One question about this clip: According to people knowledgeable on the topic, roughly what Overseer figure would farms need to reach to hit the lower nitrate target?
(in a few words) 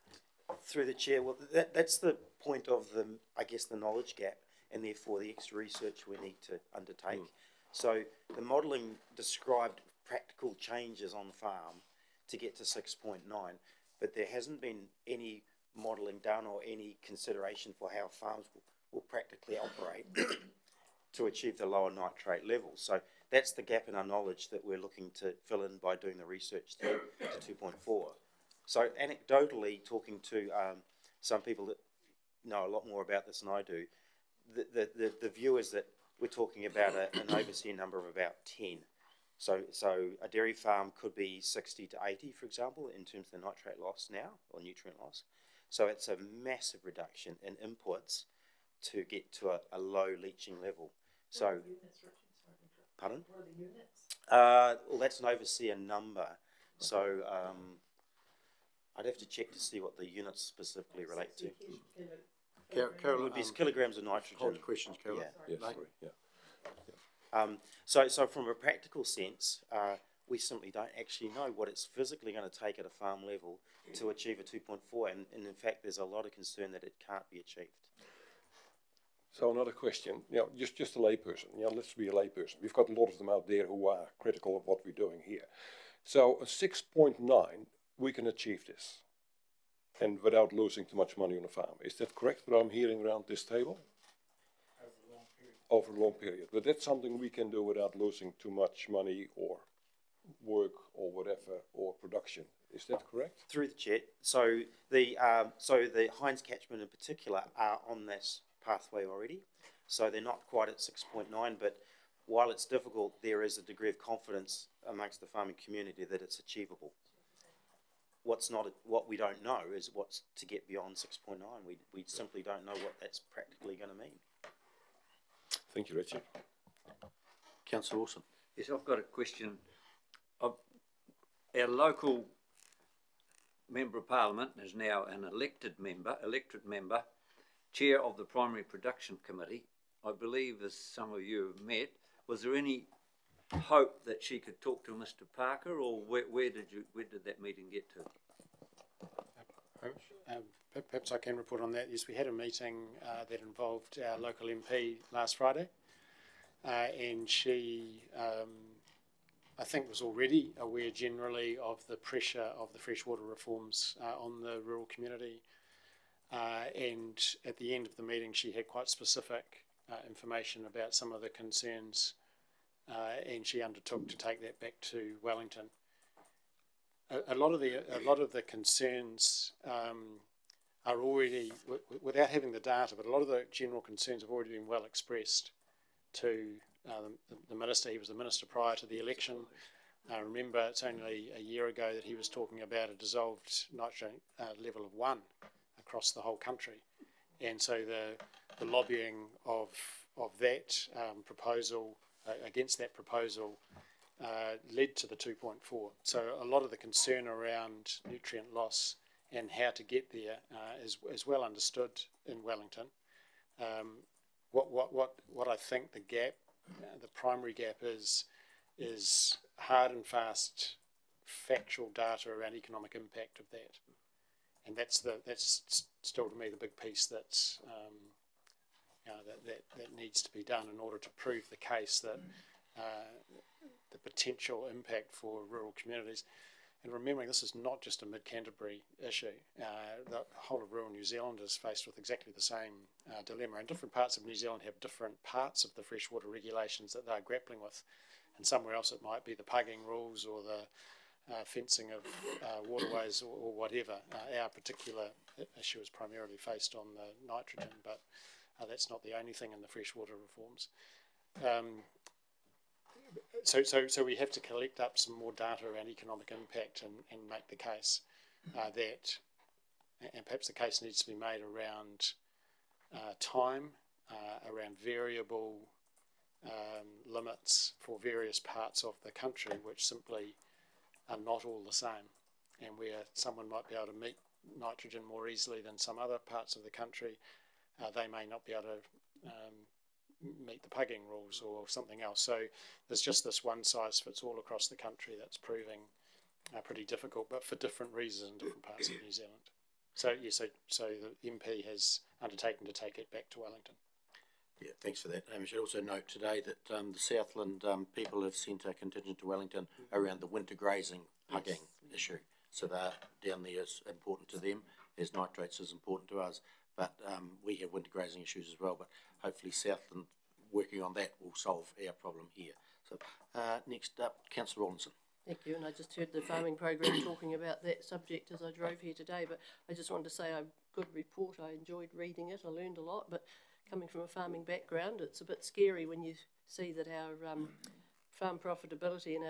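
10.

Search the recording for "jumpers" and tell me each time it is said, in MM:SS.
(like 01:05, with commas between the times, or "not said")
not said.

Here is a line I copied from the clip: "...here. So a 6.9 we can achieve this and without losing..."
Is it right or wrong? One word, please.
right.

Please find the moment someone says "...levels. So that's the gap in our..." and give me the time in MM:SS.
00:22.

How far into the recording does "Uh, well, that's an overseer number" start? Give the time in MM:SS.
00:54.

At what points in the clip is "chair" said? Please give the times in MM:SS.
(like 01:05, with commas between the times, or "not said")
00:00, 02:17.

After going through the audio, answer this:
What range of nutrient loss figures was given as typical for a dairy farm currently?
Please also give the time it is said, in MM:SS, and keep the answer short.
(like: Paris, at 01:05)
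60 to 80, at 00:41.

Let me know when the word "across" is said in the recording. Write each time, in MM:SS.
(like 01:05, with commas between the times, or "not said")
03:15, 04:54.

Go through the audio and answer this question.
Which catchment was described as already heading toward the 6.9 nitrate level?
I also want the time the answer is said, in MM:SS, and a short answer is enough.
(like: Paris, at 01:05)
Hinds, at 01:46.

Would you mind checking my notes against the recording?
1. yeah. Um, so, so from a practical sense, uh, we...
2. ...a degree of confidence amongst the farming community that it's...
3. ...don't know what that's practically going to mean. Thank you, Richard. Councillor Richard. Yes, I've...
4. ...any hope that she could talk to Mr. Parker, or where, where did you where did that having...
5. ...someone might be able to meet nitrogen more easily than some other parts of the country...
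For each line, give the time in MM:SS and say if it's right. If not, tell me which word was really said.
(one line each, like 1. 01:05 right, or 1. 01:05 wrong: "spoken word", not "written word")
1. 01:07 right
2. 01:53 right
3. 02:02 wrong: "Wilson", not "Richard"
4. 02:22 wrong: "meeting", not "having"
5. 04:43 right.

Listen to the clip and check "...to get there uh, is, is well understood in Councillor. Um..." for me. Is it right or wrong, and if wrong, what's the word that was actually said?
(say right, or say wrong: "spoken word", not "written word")
wrong: "Wellington", not "Councillor".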